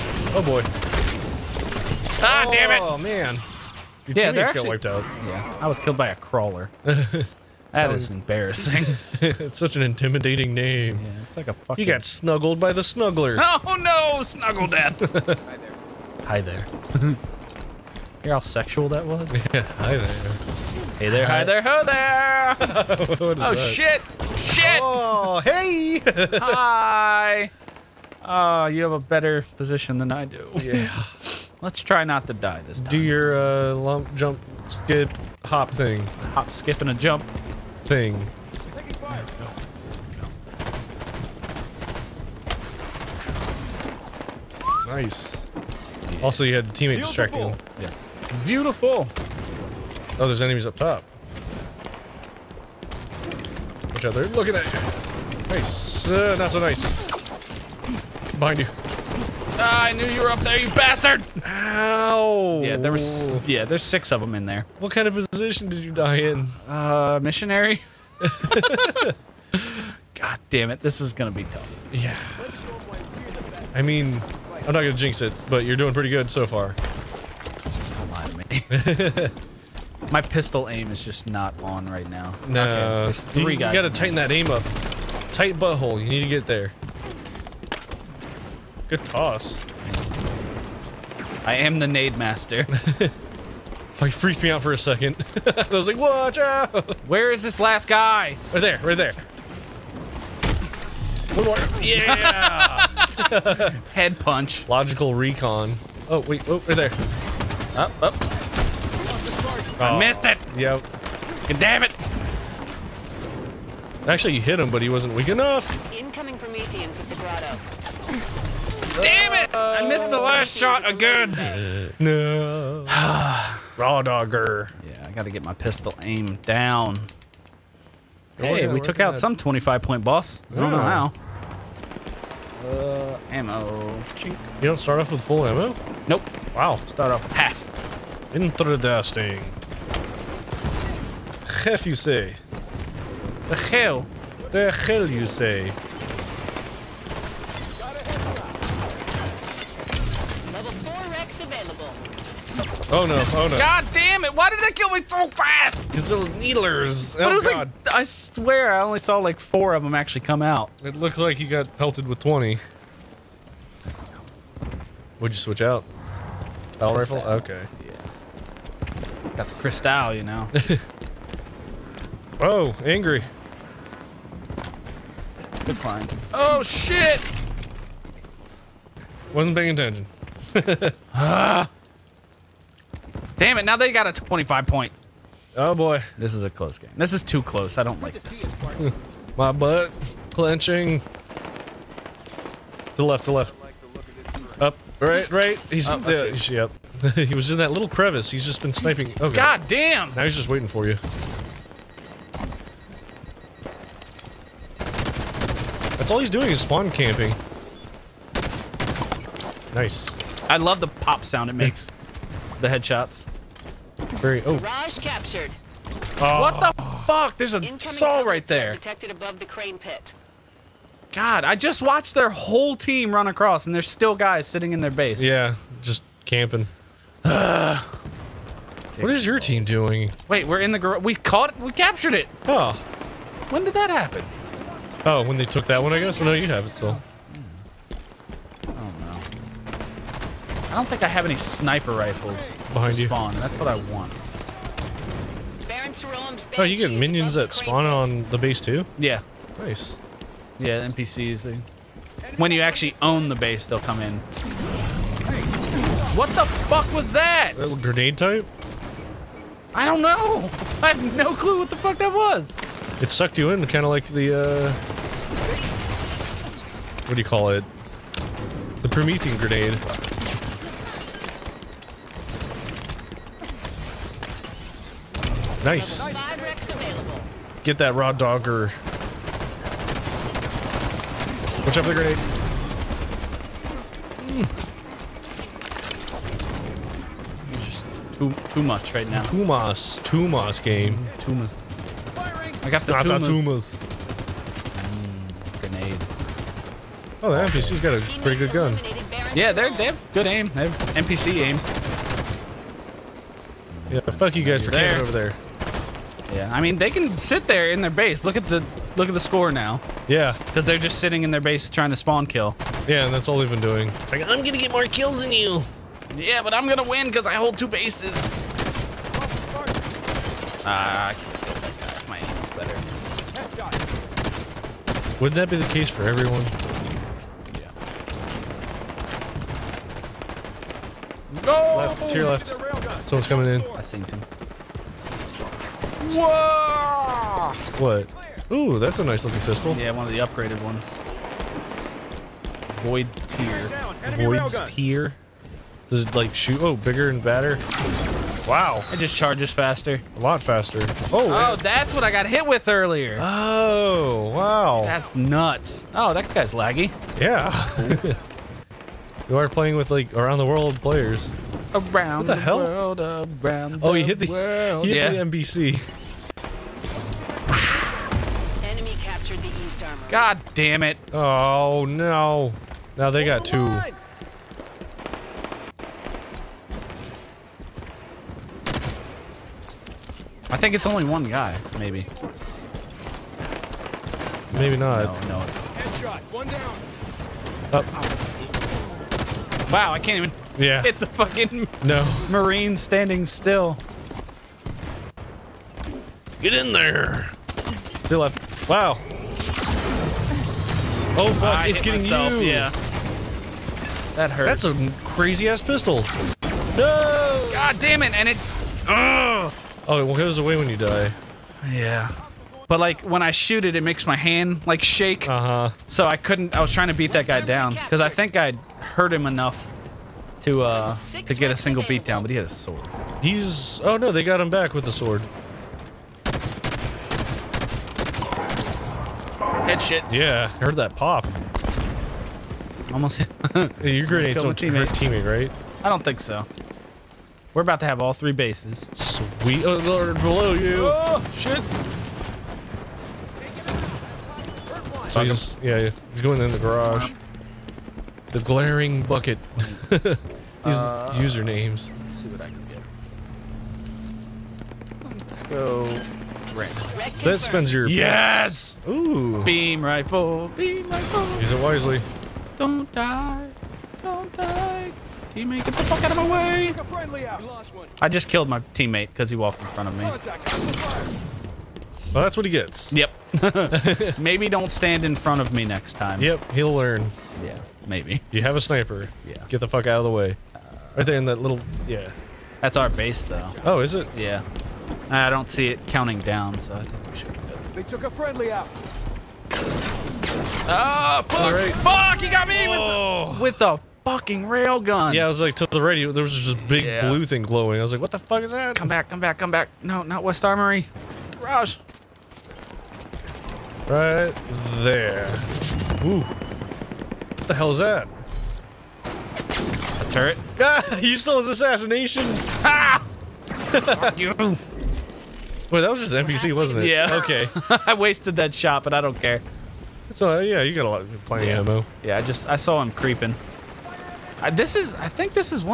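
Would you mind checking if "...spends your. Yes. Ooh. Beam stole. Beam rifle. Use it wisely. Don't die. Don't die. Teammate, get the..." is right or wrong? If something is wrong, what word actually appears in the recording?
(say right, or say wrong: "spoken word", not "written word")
wrong: "rifle", not "stole".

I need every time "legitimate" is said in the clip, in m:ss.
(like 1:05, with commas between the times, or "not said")
not said.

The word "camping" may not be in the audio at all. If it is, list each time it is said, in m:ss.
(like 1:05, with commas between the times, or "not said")
3:26, 3:46, 5:04.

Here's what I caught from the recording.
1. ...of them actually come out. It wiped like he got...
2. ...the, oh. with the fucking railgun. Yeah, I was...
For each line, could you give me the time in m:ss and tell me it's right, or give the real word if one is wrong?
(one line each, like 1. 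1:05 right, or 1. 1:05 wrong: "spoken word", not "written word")
1. 2:39 wrong: "looked", not "wiped"
2. 8:12 right.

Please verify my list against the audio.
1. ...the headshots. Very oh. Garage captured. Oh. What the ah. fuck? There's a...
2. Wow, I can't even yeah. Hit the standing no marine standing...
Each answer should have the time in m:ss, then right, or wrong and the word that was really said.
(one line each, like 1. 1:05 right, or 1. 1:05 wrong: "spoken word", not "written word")
1. 3:32 right
2. 6:29 wrong: "fucking", not "standing".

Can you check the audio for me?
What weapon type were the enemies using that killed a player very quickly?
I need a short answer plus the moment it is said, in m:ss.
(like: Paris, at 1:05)
Needlers, at 2:36.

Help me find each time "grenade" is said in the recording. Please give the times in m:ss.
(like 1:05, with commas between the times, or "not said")
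4:17, 4:29, 4:41, 4:55, 7:14.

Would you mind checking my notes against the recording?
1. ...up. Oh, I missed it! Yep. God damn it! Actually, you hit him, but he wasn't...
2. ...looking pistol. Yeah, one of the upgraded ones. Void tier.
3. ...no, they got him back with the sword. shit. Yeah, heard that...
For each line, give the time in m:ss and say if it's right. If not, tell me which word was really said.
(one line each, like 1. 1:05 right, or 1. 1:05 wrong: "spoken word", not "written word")
1. 1:48 right
2. 5:39 right
3. 7:03 right.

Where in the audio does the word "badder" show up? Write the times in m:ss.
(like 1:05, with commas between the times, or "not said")
5:47.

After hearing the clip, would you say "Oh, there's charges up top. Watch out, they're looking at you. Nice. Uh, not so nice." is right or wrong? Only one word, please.
wrong.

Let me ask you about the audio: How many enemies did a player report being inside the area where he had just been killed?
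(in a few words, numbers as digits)
Six.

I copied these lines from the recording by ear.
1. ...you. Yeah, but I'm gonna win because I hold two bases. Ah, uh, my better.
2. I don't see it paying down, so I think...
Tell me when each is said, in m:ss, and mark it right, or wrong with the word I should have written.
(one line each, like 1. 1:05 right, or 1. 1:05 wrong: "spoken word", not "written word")
1. 5:15 right
2. 8:05 wrong: "counting", not "paying".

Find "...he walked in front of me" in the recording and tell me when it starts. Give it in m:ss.
7:49.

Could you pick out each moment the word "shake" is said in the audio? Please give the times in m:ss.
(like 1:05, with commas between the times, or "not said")
6:54.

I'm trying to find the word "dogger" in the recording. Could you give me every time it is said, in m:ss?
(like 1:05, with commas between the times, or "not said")
2:04, 4:38.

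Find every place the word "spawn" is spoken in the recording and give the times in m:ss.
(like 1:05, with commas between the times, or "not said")
3:26, 4:03, 4:07, 5:11.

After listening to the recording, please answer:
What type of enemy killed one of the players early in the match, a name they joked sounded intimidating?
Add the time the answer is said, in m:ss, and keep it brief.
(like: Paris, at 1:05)
Crawler, at 0:06.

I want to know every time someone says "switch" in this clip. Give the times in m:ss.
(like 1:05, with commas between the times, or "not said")
2:45.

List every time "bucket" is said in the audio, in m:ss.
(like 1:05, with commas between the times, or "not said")
7:29.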